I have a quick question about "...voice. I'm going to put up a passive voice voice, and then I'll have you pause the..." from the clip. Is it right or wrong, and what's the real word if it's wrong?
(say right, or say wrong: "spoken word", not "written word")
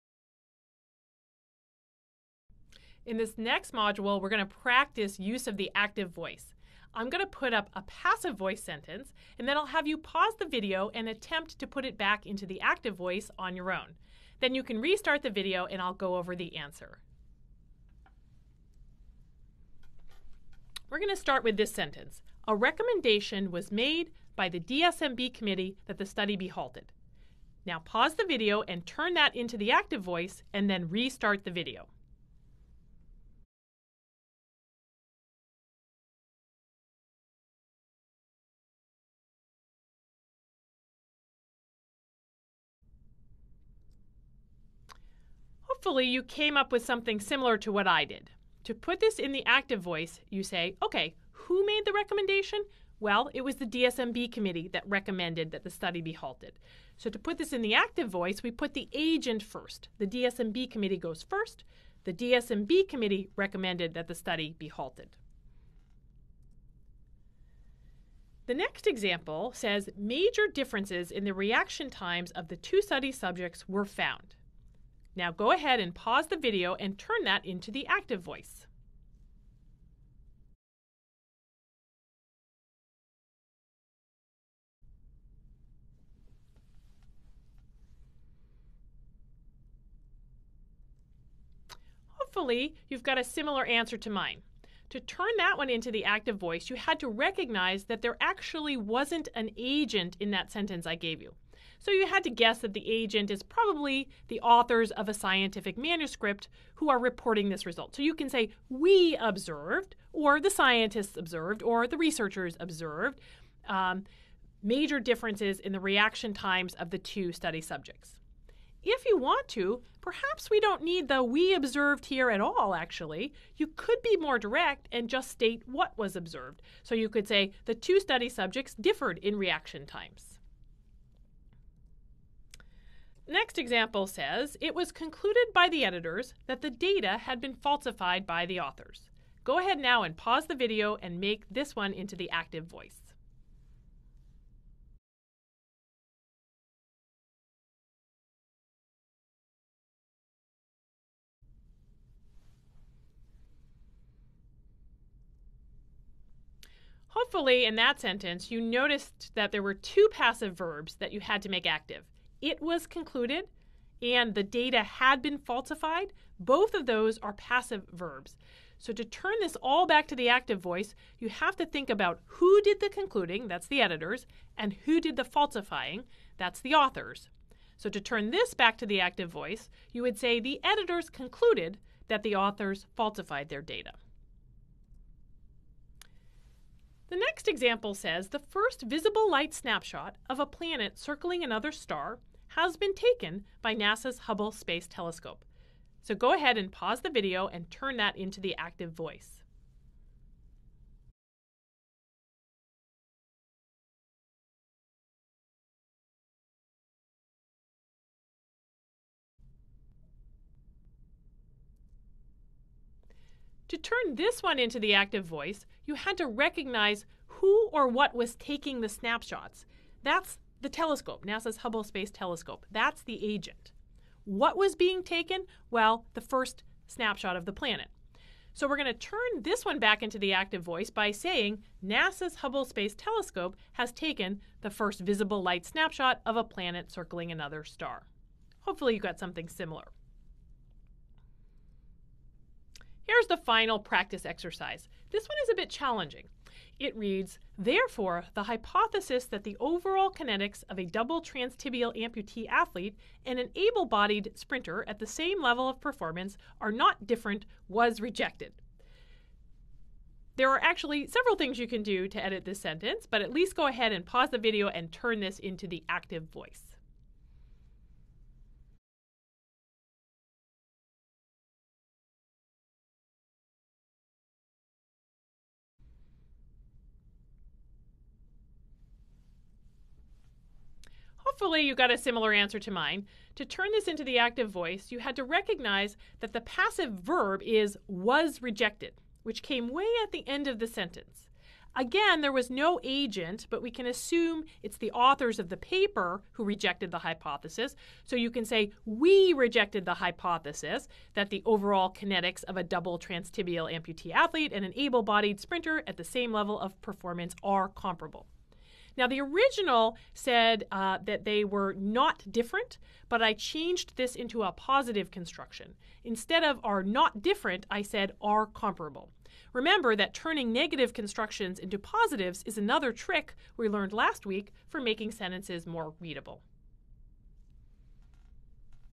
wrong: "sentence", not "voice".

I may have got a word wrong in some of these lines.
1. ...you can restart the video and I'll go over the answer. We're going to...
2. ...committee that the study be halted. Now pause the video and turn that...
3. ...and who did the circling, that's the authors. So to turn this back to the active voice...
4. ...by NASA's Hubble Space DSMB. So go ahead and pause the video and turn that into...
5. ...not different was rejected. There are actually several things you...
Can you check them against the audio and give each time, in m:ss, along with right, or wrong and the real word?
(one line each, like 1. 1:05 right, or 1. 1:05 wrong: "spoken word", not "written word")
1. 0:14 right
2. 0:25 right
3. 2:54 wrong: "falsifying", not "circling"
4. 3:13 wrong: "Telescope", not "DSMB"
5. 4:16 right.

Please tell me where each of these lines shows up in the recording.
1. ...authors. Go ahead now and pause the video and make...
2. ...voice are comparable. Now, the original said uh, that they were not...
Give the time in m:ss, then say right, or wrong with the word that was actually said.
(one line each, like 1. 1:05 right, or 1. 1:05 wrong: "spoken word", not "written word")
1. 2:18 right
2. 5:06 wrong: "performance", not "voice".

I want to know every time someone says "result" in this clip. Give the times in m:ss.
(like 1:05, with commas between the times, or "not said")
1:47.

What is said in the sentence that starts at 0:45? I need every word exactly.
Hopefully, you came up with something similar to what I did.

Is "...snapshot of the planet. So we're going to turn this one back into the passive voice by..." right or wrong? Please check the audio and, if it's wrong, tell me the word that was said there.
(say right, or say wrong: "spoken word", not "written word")
wrong: "active", not "passive".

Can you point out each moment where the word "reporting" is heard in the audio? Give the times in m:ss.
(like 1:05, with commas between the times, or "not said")
1:46.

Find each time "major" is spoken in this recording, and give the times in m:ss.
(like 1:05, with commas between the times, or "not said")
1:09, 1:54.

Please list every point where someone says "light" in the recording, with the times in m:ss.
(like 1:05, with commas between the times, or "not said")
3:09, 3:55.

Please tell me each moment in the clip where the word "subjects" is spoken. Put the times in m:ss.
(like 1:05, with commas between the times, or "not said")
1:13, 1:57, 2:08.